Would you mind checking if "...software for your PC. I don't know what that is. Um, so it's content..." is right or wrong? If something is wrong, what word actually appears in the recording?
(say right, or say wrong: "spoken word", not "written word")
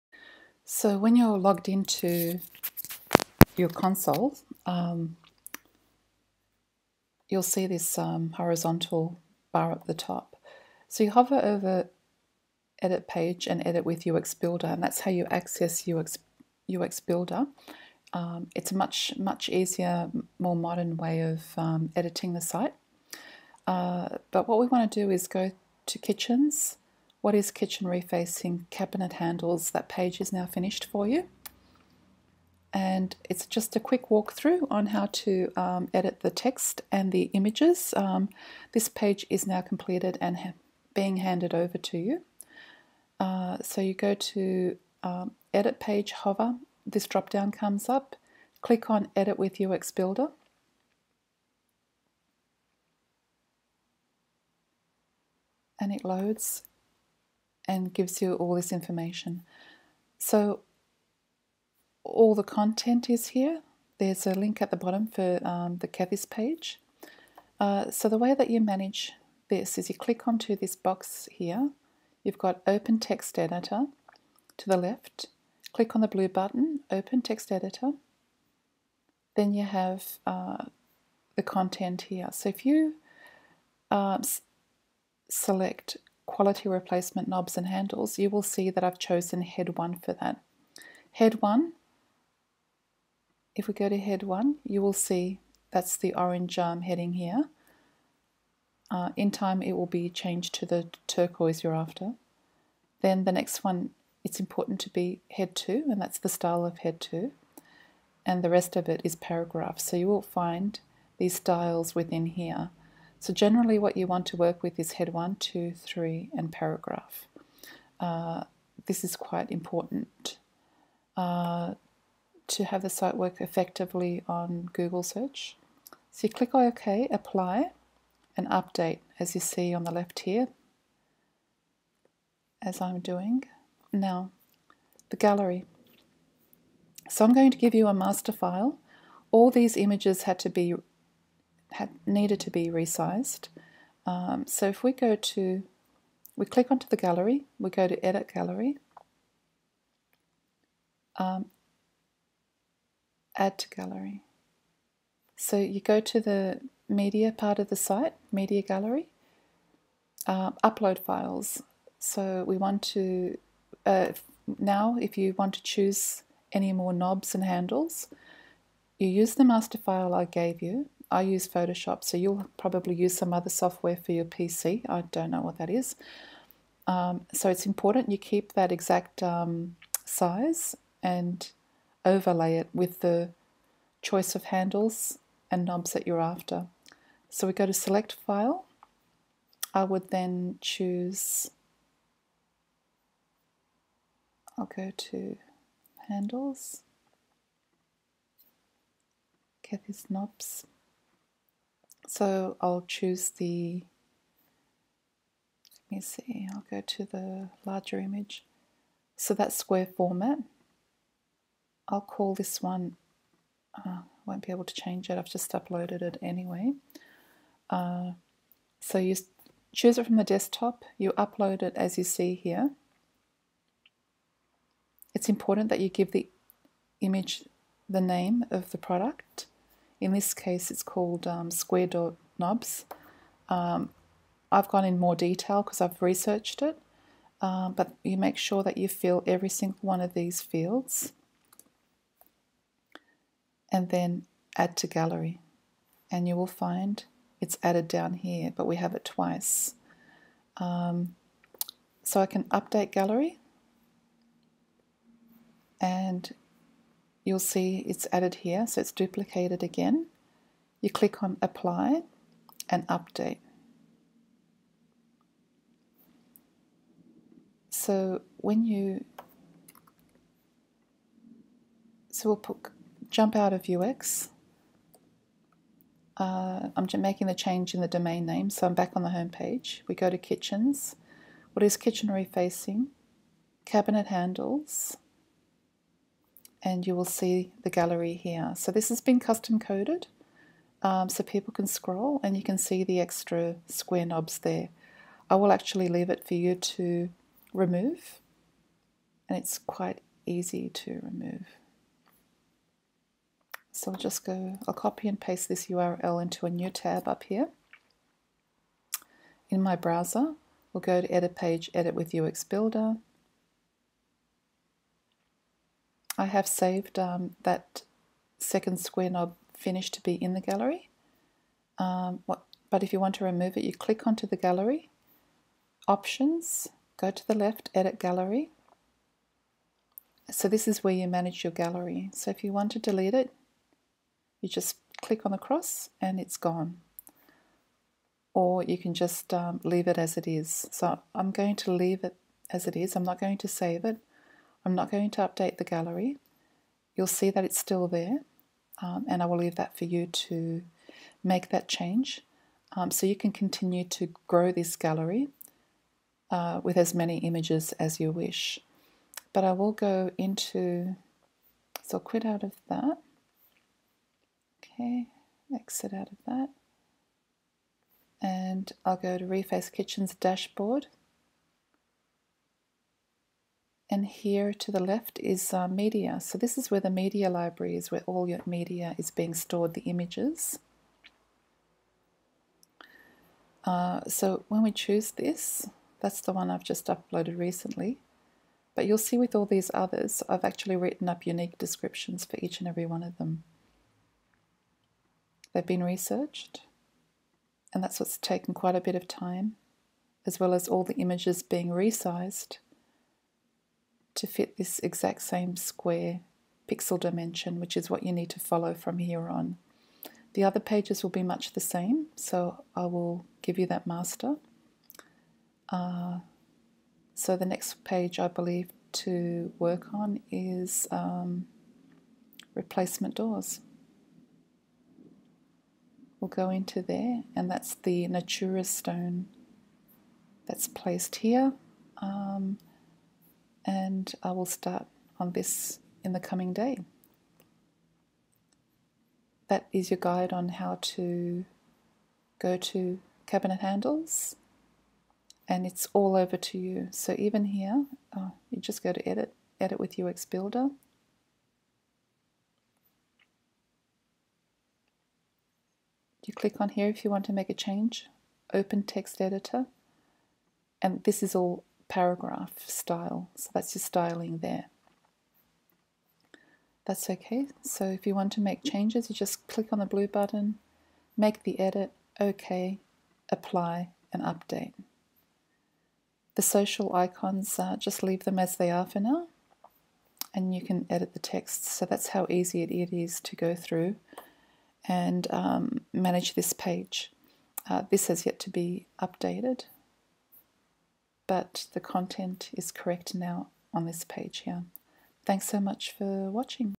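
wrong: "important", not "content".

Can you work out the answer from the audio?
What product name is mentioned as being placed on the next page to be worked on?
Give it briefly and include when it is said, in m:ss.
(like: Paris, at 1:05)
Natura stone, at 7:08.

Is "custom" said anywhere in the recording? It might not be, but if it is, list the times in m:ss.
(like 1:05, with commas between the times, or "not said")
4:49.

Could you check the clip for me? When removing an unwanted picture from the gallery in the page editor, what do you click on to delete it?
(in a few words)
The cross.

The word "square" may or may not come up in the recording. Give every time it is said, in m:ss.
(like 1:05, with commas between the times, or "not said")
3:29, 3:51, 4:53, 5:18, 6:45.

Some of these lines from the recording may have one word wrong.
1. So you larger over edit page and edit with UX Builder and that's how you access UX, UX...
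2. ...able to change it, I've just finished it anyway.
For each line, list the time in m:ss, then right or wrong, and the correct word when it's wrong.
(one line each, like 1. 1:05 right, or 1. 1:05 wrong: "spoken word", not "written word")
1. 0:10 wrong: "hover", not "larger"
2. 3:34 wrong: "uploaded", not "finished".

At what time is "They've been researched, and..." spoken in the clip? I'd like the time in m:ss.
6:35.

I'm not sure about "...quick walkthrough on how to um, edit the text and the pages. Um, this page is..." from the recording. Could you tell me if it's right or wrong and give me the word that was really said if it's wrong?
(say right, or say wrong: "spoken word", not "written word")
wrong: "images", not "pages".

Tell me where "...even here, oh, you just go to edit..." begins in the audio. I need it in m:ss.
7:27.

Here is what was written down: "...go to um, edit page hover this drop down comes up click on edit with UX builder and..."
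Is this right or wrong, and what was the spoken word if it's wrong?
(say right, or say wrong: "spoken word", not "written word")
right.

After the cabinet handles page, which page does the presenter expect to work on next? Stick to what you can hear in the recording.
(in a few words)
Replacement doors.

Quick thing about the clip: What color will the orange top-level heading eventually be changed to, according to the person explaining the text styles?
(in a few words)
Turquoise.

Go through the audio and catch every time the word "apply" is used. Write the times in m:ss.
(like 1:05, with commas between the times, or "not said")
2:07, 4:21, 7:53.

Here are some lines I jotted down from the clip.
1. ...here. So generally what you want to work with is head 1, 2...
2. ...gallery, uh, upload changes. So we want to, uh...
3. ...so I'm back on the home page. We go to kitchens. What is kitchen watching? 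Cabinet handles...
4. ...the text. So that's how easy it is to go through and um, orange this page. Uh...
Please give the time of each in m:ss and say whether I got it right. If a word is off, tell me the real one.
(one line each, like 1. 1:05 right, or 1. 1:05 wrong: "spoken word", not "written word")
1. 1:52 right
2. 2:38 wrong: "files", not "changes"
3. 4:38 wrong: "refacing", not "watching"
4. 8:01 wrong: "manage", not "orange".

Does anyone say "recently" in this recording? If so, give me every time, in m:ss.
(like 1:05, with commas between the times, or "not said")
6:27.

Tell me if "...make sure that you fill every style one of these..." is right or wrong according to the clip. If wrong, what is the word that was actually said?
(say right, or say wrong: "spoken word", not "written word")
wrong: "single", not "style".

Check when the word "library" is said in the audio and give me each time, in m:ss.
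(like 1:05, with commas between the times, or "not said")
6:17.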